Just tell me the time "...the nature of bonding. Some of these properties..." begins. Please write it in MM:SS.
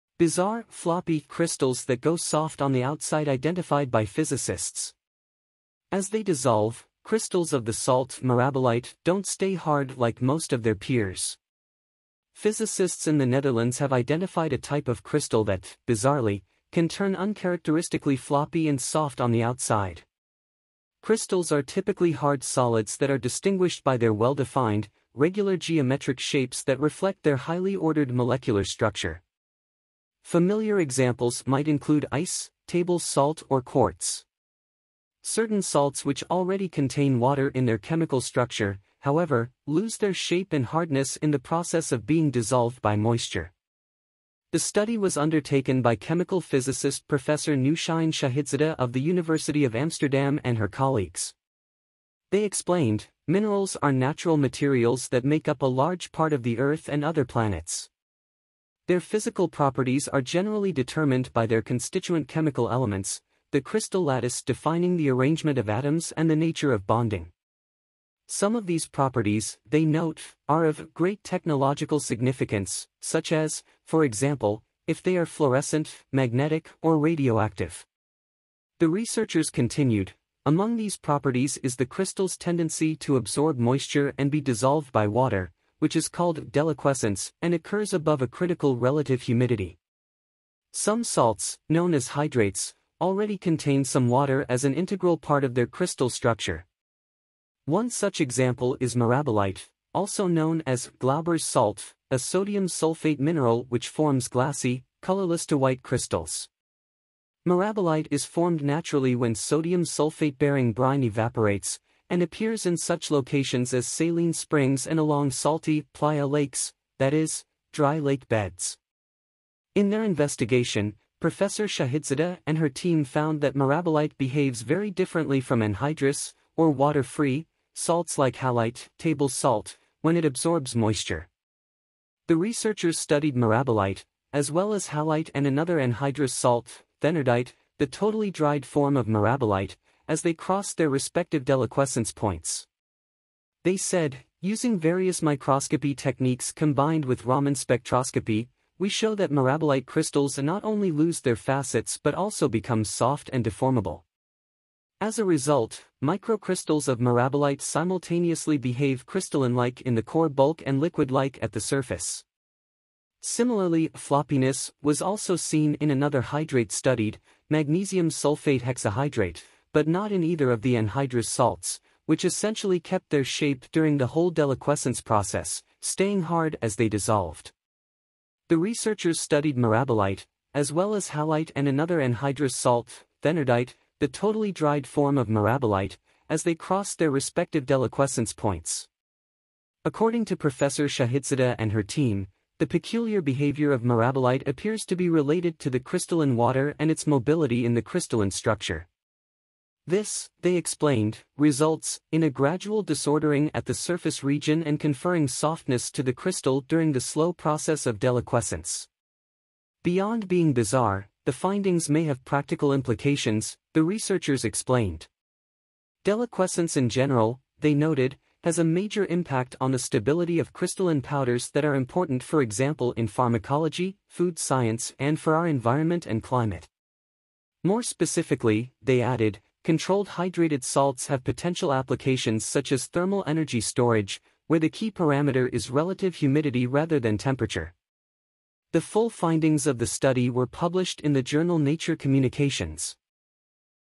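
01:06.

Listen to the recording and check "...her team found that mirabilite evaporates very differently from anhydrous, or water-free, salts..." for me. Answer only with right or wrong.
wrong.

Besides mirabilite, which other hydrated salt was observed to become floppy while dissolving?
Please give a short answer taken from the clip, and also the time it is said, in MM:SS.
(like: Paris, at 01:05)
magnesium sulfate hexahydrate, at 02:47.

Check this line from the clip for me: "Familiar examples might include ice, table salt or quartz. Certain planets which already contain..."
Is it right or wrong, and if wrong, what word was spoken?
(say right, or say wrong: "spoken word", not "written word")
wrong: "salts", not "planets".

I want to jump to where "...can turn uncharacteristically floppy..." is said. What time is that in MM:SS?
00:16.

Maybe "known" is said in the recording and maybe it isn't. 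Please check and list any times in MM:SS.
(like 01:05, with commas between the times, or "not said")
01:31, 01:40.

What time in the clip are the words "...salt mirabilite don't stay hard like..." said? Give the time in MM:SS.
00:07.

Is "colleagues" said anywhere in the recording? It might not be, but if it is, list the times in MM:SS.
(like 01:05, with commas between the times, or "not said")
00:50.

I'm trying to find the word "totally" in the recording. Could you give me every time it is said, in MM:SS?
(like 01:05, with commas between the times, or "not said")
02:17, 03:04.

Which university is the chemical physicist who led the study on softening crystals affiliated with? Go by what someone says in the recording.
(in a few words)
University of Amsterdam.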